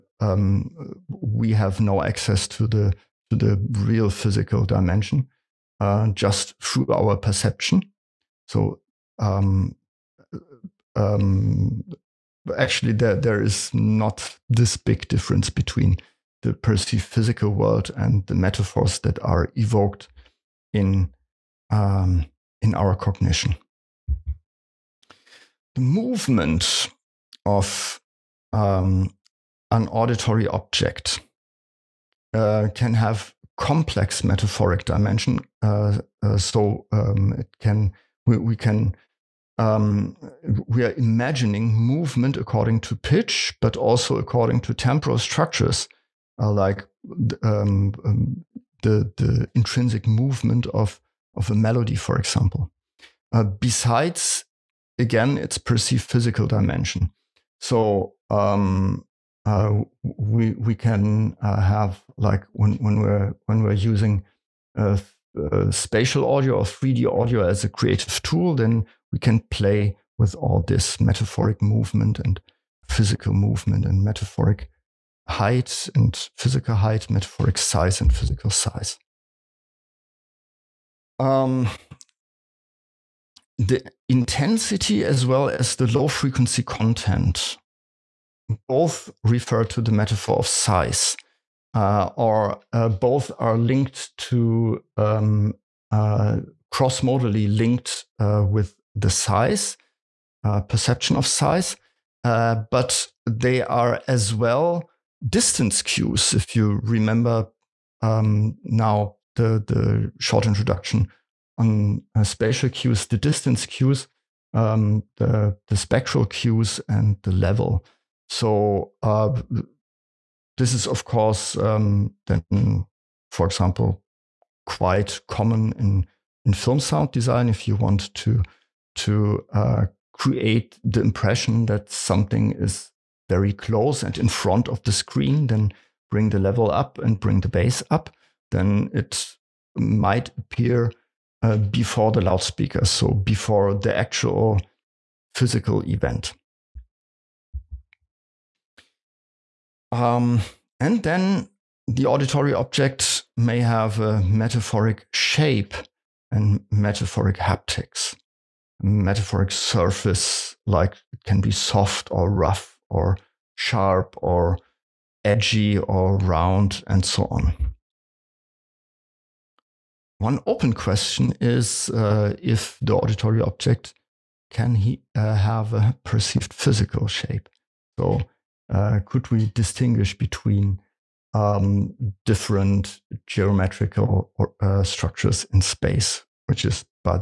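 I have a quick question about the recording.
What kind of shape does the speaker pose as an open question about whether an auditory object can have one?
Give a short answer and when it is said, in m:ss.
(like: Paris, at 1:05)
perceived physical shape, at 2:56.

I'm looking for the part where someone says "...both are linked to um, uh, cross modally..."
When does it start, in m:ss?
1:32.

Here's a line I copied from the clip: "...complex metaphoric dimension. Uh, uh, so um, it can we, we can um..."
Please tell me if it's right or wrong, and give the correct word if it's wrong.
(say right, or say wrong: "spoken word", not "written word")
right.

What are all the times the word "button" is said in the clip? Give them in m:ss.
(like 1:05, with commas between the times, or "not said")
not said.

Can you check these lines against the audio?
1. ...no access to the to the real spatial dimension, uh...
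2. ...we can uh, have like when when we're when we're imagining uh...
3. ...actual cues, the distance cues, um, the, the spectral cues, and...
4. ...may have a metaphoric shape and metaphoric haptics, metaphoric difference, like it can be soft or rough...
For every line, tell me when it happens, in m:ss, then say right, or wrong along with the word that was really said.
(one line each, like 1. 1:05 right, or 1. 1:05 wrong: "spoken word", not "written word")
1. 0:01 wrong: "physical", not "spatial"
2. 1:00 wrong: "using", not "imagining"
3. 1:52 wrong: "spatial", not "actual"
4. 2:33 wrong: "surface", not "difference".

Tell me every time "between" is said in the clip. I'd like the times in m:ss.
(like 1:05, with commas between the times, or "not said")
0:15, 3:00.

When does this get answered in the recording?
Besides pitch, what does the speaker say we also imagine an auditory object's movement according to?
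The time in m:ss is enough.
0:44.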